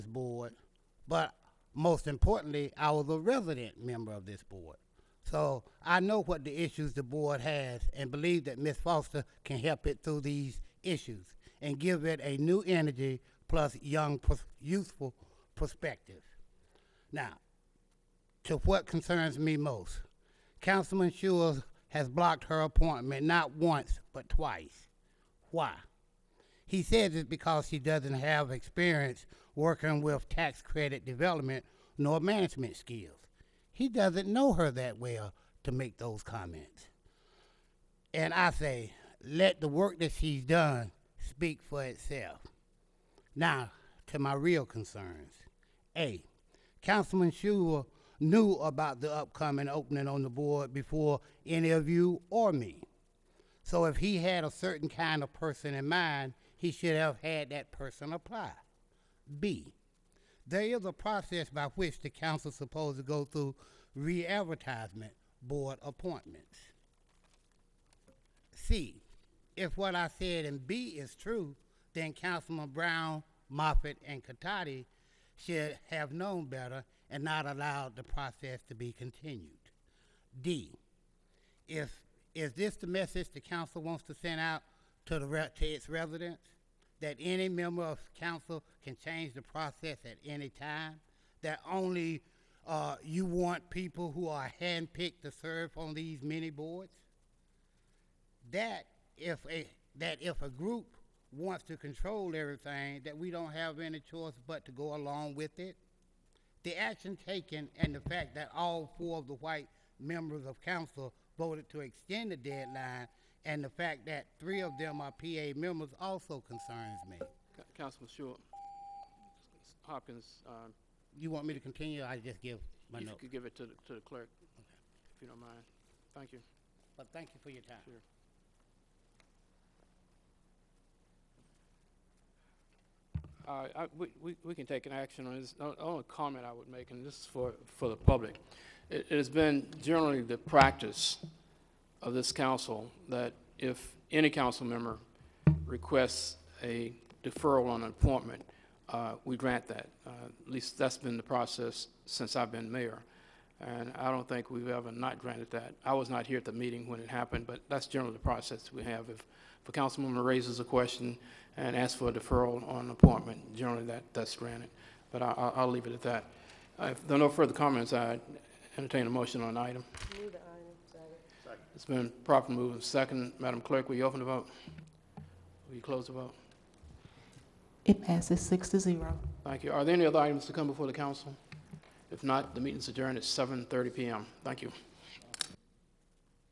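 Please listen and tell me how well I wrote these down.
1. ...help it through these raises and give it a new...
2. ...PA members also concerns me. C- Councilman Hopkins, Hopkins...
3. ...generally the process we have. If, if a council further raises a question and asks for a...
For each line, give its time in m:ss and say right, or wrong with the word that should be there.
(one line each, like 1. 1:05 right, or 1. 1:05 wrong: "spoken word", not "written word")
1. 0:09 wrong: "issues", not "raises"
2. 1:55 wrong: "Short", not "Hopkins"
3. 2:37 wrong: "member", not "further".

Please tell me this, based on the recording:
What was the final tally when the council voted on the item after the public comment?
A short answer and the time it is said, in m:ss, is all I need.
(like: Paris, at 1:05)
6 to 0, at 2:58.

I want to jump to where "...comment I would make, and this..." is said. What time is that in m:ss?
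2:16.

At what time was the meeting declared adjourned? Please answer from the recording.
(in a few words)
7:30 p.m.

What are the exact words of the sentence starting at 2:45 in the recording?
But I, will leave it at that.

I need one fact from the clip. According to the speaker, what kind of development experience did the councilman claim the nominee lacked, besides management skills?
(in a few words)
Tax credit development.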